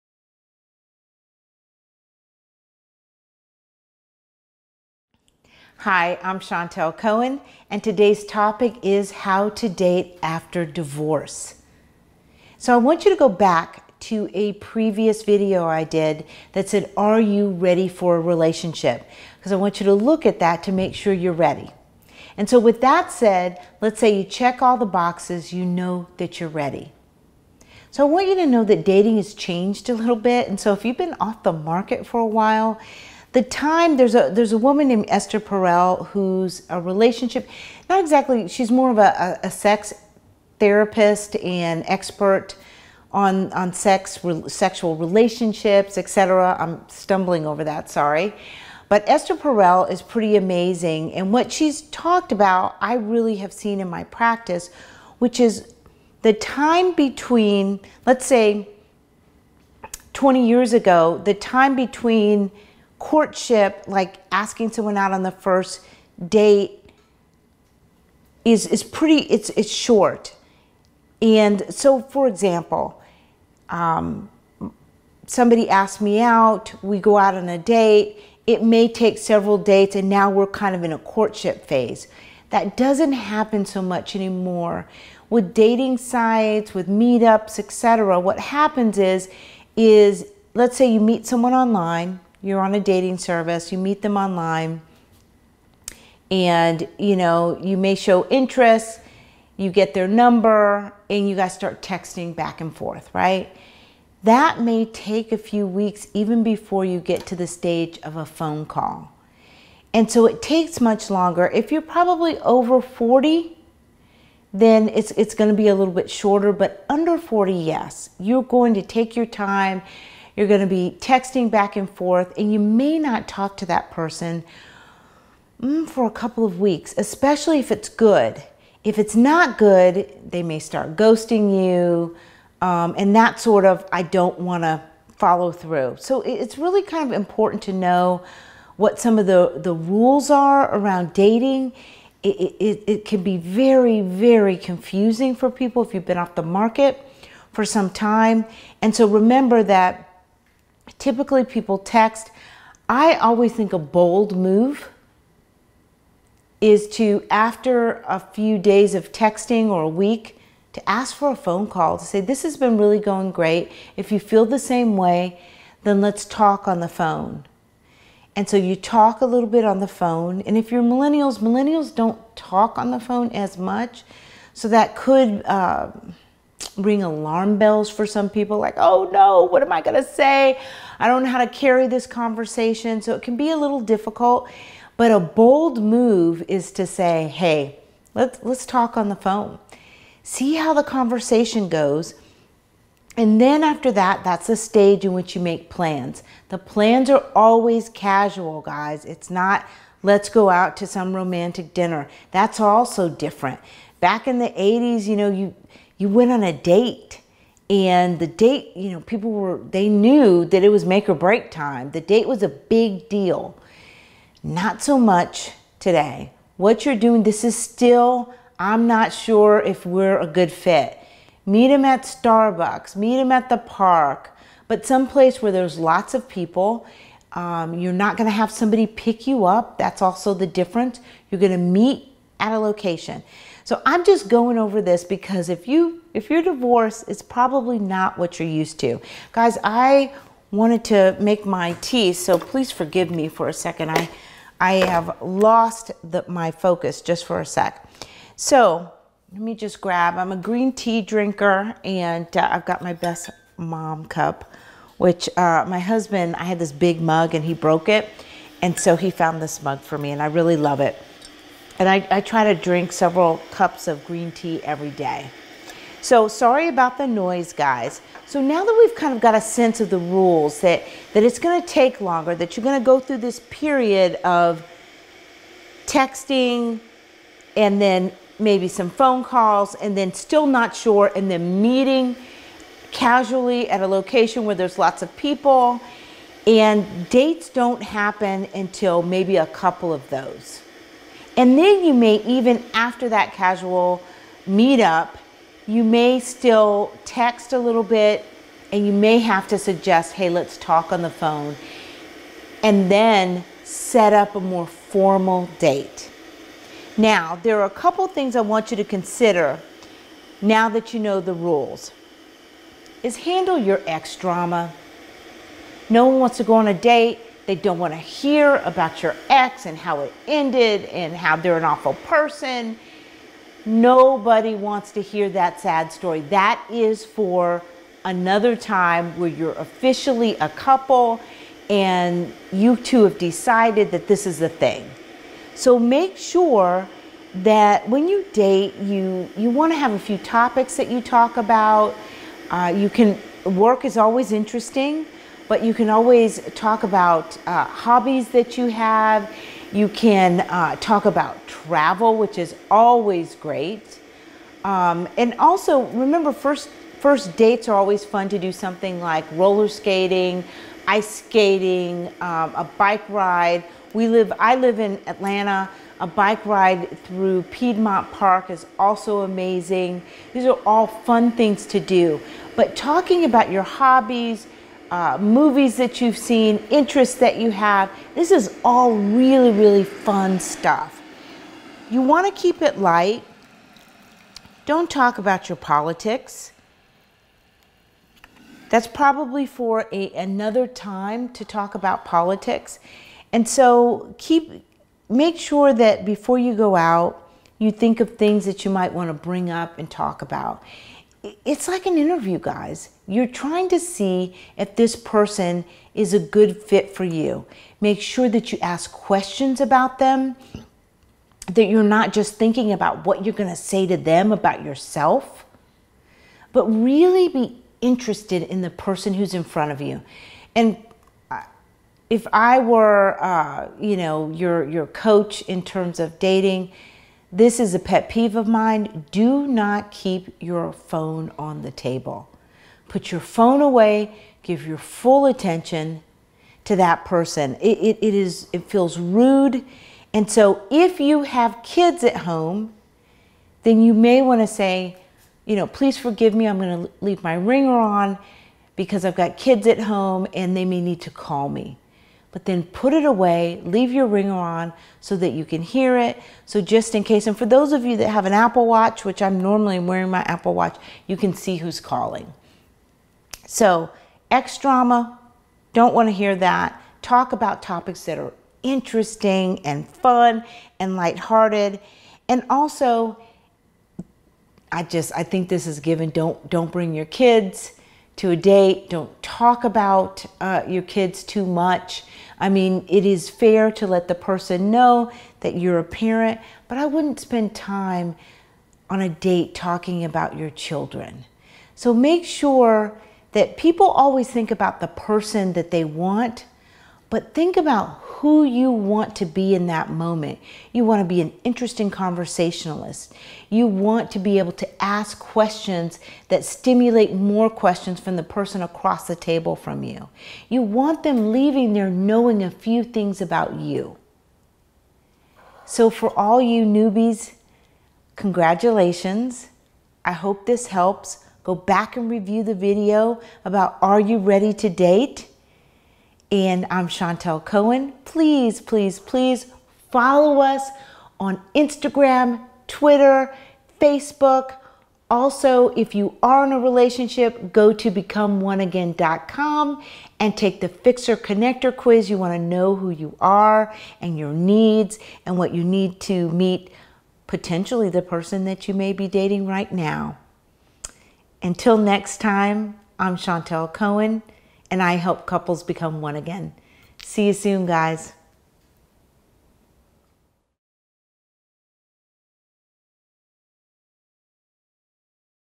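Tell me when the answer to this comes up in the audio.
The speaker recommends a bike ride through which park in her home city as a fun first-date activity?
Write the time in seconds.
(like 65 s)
367 s.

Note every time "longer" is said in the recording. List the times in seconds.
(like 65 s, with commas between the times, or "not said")
111 s, 271 s.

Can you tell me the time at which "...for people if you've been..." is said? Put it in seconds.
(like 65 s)
145 s.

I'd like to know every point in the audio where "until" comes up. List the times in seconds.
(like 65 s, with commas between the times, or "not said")
288 s, 551 s.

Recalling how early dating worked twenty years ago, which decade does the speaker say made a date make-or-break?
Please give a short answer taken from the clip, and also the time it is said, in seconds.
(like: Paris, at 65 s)
the 80s, at 204 s.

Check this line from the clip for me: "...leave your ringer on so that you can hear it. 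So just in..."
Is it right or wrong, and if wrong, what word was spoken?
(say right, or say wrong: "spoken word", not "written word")
right.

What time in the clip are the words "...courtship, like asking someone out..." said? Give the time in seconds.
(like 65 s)
63 s.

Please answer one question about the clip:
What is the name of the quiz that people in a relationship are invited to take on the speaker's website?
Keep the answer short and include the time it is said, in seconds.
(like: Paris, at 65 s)
Fixer Connector quiz, at 540 s.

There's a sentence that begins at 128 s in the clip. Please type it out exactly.
If it's not good, they may start ghosting you, um, and that sort of, I don't want to follow through.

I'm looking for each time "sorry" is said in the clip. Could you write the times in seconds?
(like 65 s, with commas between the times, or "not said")
47 s, 266 s.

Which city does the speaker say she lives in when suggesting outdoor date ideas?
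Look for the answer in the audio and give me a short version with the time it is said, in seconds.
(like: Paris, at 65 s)
Atlanta, at 365 s.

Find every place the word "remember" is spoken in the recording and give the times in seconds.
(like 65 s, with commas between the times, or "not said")
149 s, 355 s.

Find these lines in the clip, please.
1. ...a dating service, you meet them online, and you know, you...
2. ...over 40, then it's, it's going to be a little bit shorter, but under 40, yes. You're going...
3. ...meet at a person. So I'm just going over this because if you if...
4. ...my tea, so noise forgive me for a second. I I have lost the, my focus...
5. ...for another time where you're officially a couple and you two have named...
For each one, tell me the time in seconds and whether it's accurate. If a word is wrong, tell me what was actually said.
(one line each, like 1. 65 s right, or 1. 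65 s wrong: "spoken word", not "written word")
1. 92 s right
2. 112 s right
3. 231 s wrong: "location", not "person"
4. 241 s wrong: "please", not "noise"
5. 327 s wrong: "decided", not "named".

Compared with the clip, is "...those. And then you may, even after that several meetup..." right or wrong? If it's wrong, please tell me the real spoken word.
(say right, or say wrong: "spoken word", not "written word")
wrong: "casual", not "several".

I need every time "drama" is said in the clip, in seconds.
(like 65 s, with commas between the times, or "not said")
314 s, 464 s.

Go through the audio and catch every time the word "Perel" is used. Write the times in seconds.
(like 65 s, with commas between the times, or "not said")
35 s, 49 s.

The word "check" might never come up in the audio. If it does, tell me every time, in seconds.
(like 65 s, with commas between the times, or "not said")
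24 s.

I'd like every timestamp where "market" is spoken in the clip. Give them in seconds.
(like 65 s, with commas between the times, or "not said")
31 s, 146 s.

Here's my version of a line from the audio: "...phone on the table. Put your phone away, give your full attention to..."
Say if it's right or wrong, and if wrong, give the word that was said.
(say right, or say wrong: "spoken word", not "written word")
right.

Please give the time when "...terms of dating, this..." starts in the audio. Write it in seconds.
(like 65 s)
425 s.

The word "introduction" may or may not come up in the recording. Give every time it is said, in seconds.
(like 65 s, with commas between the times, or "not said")
not said.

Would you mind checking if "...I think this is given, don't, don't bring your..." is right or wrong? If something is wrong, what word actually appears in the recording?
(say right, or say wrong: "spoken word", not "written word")
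right.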